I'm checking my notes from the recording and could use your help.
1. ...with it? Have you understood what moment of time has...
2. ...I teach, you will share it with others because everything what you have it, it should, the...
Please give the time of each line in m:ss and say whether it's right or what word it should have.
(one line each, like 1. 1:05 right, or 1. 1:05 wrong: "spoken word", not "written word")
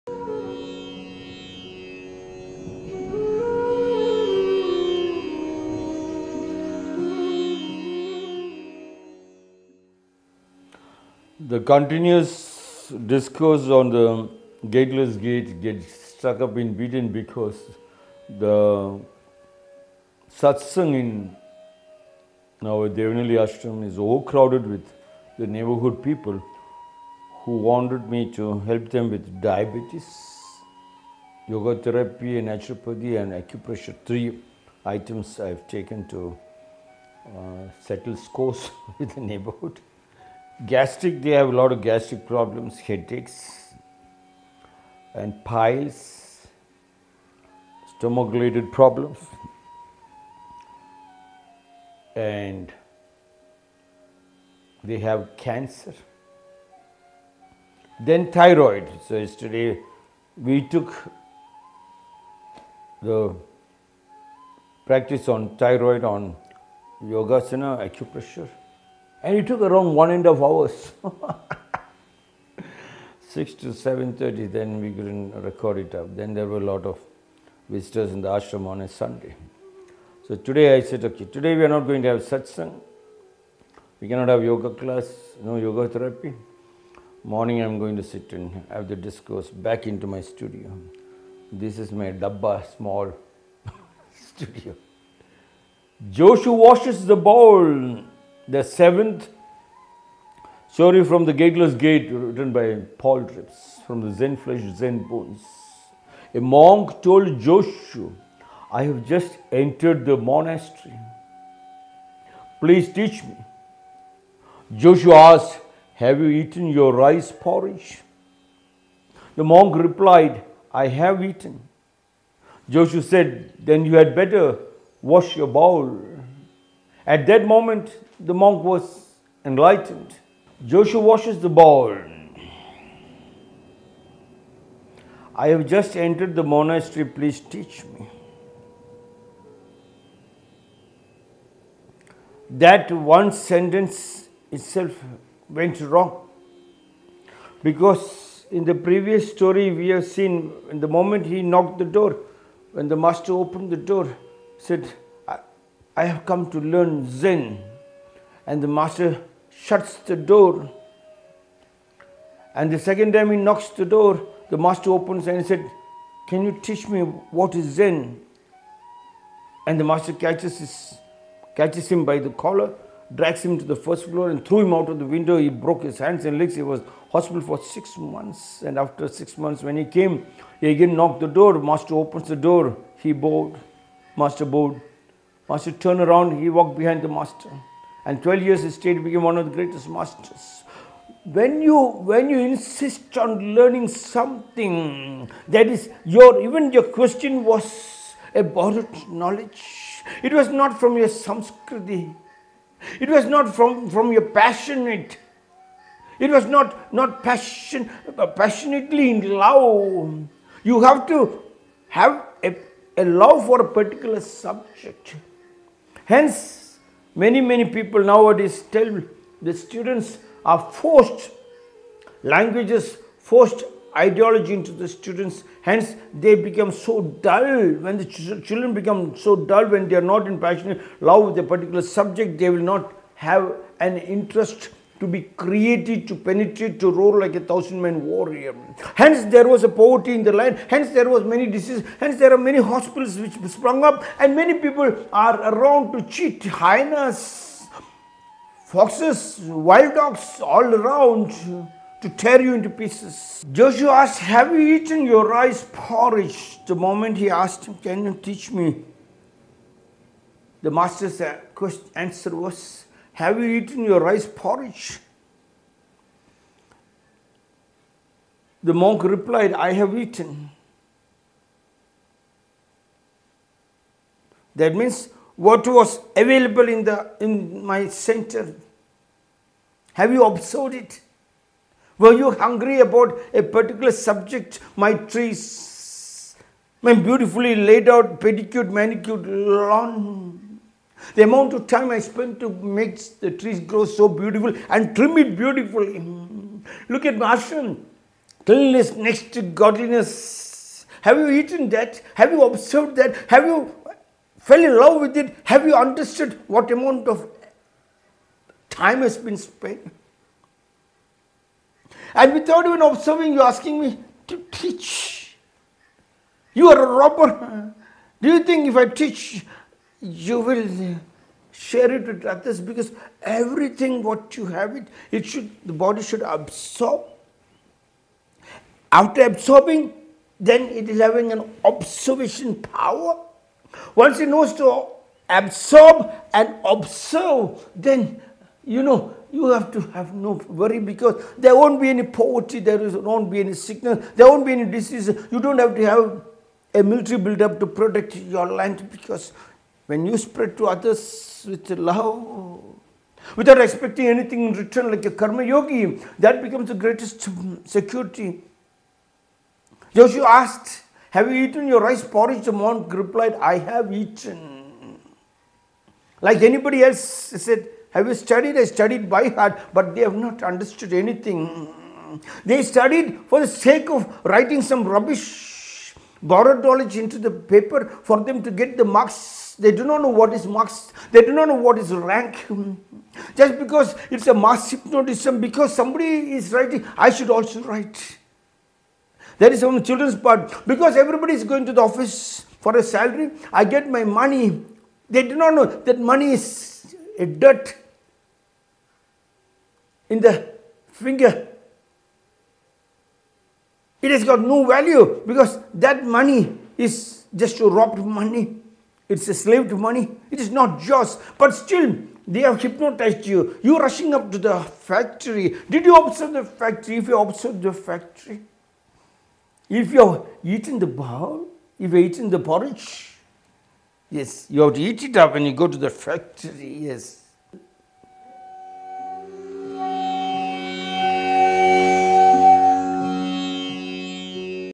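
1. 5:05 wrong: "amount", not "moment"
2. 5:18 right.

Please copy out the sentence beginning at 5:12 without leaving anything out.
And without even observing, you're asking me to teach.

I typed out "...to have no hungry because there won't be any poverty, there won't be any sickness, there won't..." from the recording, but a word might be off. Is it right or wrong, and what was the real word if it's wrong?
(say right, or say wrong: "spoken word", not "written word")
wrong: "worry", not "hungry".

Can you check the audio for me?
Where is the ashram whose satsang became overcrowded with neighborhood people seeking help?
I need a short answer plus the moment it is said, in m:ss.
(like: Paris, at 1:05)
Devanahalli, at 0:22.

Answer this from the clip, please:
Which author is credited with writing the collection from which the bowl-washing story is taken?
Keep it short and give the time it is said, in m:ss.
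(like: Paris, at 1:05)
Paul Reps, at 1:43.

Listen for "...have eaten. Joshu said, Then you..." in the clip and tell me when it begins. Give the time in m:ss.
2:00.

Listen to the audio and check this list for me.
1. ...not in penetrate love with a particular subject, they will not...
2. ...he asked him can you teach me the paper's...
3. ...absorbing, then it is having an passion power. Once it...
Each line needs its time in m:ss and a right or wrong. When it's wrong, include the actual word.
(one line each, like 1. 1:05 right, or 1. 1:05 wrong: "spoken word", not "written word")
1. 3:50 wrong: "passionate", not "penetrate"
2. 4:17 wrong: "master", not "paper"
3. 5:29 wrong: "observation", not "passion".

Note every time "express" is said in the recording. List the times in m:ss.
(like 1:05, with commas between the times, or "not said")
not said.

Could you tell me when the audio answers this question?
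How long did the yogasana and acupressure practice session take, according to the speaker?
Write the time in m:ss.
1:09.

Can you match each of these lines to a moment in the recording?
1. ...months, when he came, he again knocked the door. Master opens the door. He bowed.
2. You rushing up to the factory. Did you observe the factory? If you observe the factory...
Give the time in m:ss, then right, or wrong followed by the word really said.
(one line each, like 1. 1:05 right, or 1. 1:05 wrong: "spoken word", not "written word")
1. 2:59 right
2. 6:53 right.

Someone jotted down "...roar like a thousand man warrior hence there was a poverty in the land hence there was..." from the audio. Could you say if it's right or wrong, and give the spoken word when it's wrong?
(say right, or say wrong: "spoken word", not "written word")
right.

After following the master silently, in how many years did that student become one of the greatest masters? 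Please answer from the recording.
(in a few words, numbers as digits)
12.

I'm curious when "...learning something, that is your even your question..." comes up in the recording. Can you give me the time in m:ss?
3:13.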